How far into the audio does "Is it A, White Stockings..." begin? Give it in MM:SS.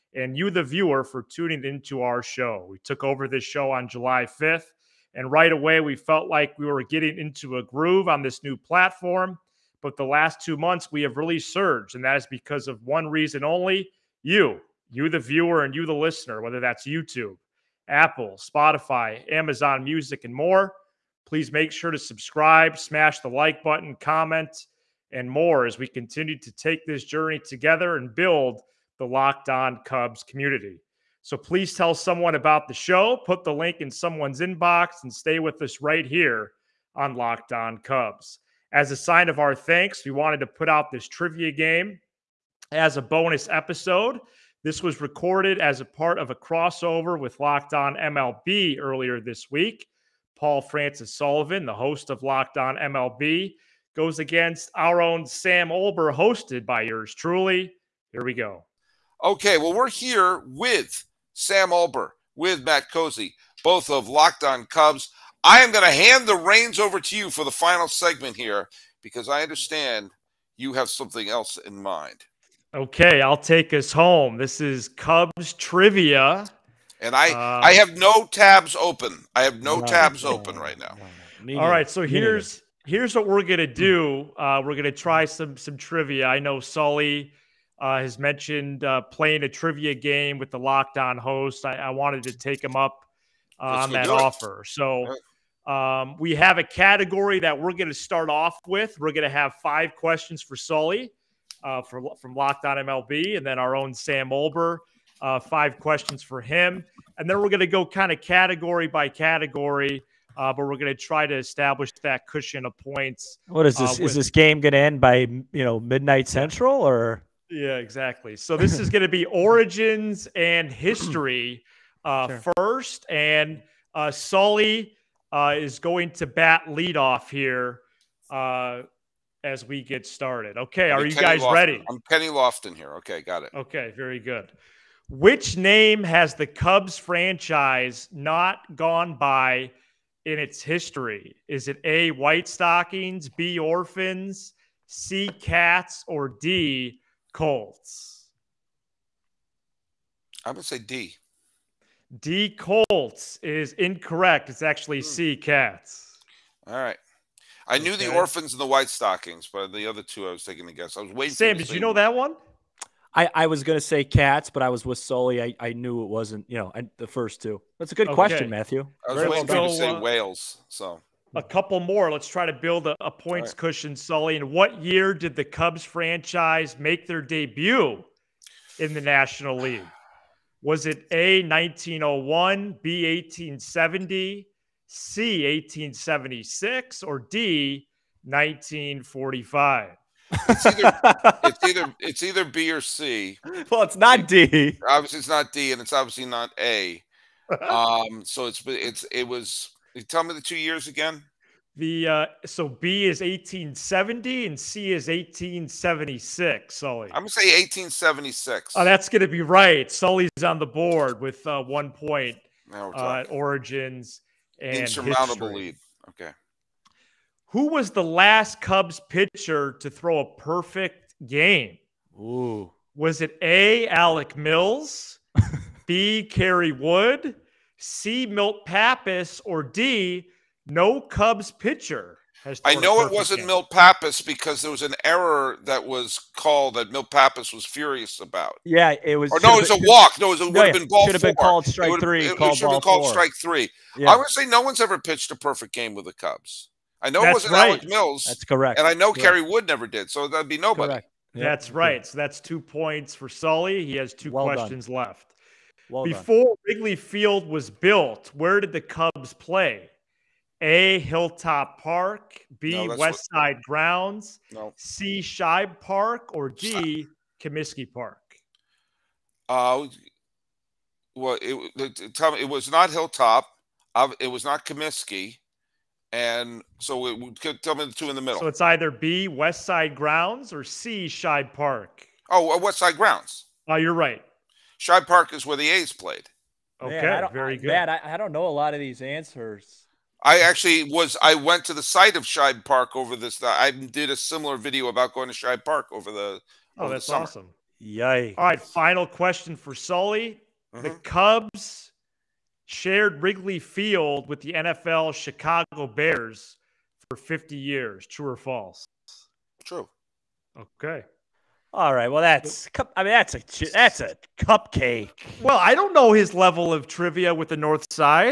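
02:21.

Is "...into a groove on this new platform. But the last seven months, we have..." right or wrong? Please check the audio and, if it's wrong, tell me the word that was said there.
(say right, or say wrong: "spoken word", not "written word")
wrong: "two", not "seven".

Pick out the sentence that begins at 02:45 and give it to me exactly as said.
I, I knew it wasn't you know I, the first two.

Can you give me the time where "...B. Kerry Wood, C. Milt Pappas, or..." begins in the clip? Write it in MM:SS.
03:45.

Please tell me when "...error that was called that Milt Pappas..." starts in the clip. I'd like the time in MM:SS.
03:55.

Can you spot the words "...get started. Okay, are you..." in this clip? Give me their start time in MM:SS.
02:09.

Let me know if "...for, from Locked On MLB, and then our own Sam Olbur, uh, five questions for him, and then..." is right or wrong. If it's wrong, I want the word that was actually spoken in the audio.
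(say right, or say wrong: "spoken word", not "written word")
right.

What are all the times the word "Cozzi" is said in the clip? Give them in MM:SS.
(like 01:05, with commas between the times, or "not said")
01:02.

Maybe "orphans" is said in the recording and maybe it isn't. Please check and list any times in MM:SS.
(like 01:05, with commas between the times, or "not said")
02:23, 02:38.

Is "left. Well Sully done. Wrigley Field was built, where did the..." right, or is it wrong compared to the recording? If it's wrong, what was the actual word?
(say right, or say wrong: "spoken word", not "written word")
wrong: "Before", not "Sully".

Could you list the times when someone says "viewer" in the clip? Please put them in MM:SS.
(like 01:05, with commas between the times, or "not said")
00:00, 00:15.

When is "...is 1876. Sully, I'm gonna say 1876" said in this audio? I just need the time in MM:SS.
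03:24.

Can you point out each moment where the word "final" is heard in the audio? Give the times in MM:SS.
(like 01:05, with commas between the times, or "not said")
01:07, 04:58.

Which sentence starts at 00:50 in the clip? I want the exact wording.
Paul Francis Sullivan, the host of Locked On MLB, goes against our own Sam Olbur, hosted by yours truly.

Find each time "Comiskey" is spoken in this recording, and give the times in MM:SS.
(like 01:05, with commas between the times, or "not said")
04:27, 04:34.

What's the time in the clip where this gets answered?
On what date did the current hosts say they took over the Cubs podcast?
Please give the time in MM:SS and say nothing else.
00:03.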